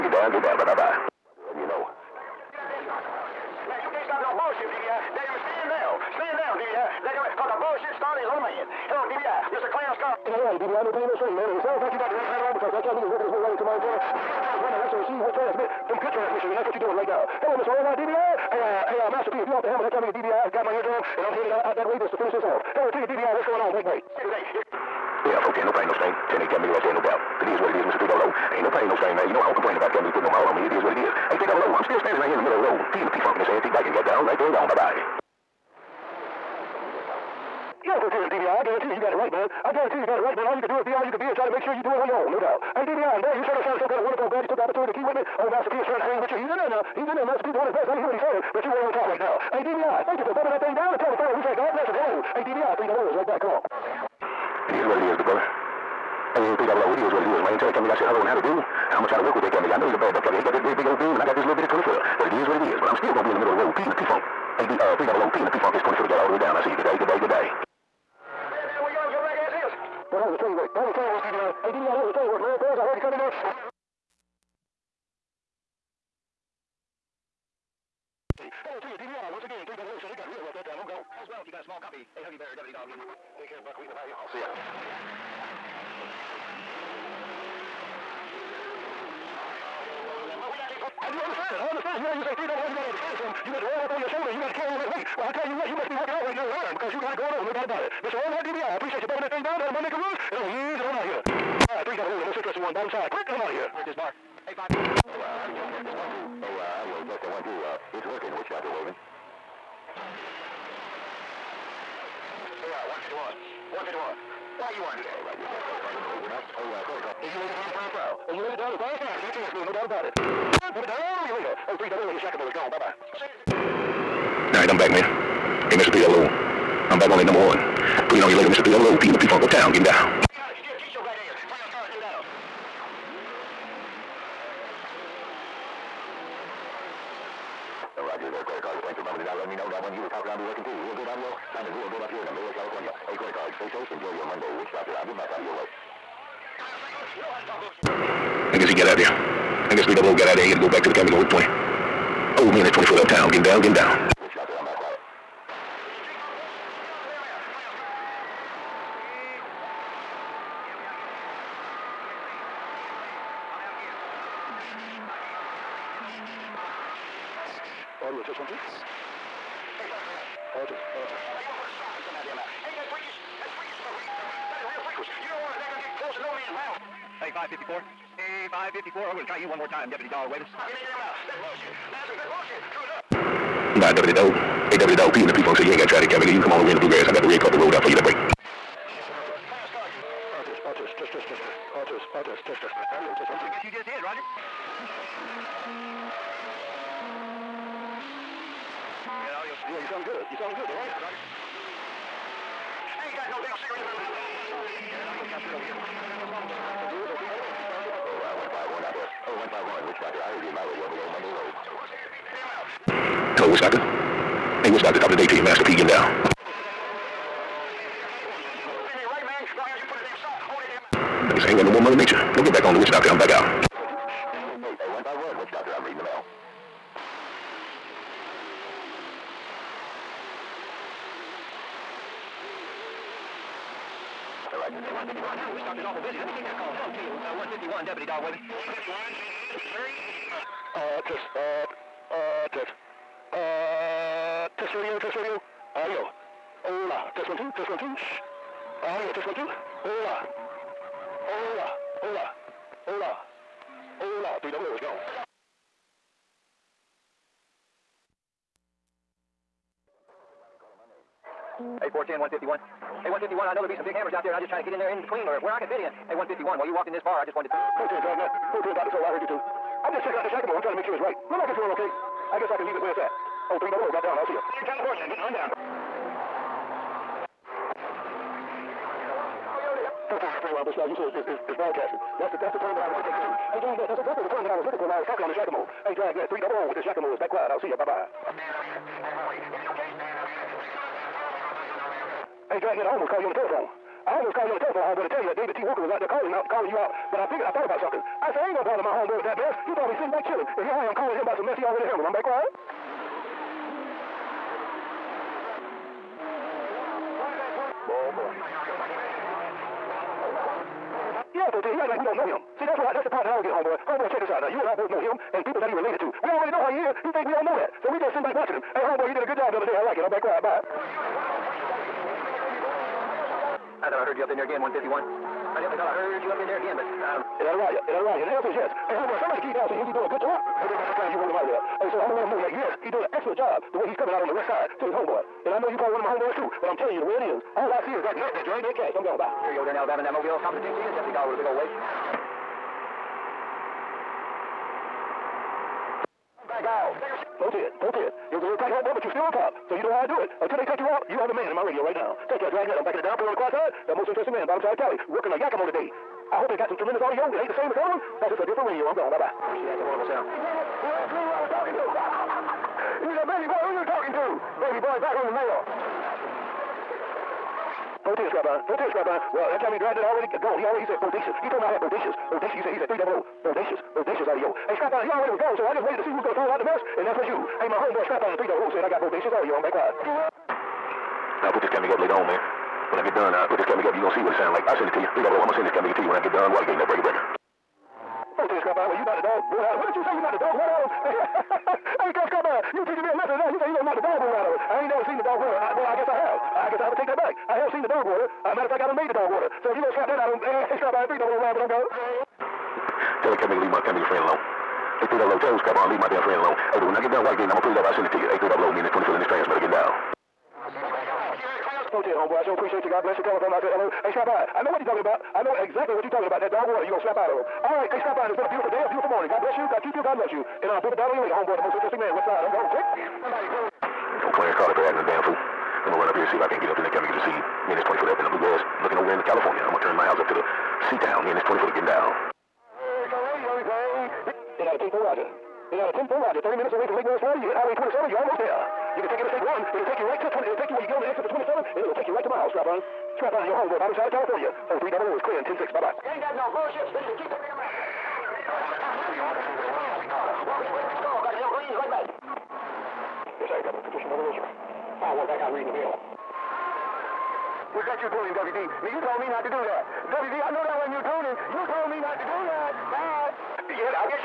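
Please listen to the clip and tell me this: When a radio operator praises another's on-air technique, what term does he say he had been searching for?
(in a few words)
Broadcasting.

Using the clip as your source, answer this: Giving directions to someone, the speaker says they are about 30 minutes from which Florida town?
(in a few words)
Lake Wales.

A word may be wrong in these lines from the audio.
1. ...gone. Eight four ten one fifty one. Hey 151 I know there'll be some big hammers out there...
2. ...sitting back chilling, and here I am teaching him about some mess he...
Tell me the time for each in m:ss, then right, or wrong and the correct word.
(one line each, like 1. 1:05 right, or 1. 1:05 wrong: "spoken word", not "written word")
1. 4:14 right
2. 4:59 wrong: "calling", not "teaching".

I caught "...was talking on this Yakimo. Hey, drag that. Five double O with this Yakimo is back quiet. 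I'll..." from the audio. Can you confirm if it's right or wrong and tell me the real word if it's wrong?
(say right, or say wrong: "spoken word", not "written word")
wrong: "Three", not "Five".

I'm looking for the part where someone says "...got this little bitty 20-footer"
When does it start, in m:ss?
1:01.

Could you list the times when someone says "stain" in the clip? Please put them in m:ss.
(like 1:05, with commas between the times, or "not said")
0:29.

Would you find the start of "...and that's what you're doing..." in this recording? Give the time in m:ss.
0:16.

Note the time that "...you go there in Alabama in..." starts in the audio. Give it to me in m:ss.
5:39.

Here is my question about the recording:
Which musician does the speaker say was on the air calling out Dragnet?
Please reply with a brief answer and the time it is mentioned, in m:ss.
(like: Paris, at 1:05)
David T. 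Walker, at 4:55.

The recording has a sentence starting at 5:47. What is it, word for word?
410, It was a little tight home run, but you're still on top.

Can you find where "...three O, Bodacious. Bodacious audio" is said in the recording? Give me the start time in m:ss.
6:12.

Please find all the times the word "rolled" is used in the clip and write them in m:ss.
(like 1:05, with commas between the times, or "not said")
3:07, 5:31.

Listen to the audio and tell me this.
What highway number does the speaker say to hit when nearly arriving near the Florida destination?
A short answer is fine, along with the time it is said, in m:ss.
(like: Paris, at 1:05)
27, at 7:17.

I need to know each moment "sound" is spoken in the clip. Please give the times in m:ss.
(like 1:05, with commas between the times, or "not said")
0:11, 6:00, 6:24.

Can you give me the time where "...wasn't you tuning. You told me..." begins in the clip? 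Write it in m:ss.
7:40.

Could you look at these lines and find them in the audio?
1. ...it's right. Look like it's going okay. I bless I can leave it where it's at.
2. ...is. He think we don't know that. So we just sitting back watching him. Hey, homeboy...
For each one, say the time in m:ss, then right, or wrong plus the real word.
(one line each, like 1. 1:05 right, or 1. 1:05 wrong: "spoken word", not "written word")
1. 4:30 wrong: "guess", not "bless"
2. 5:16 right.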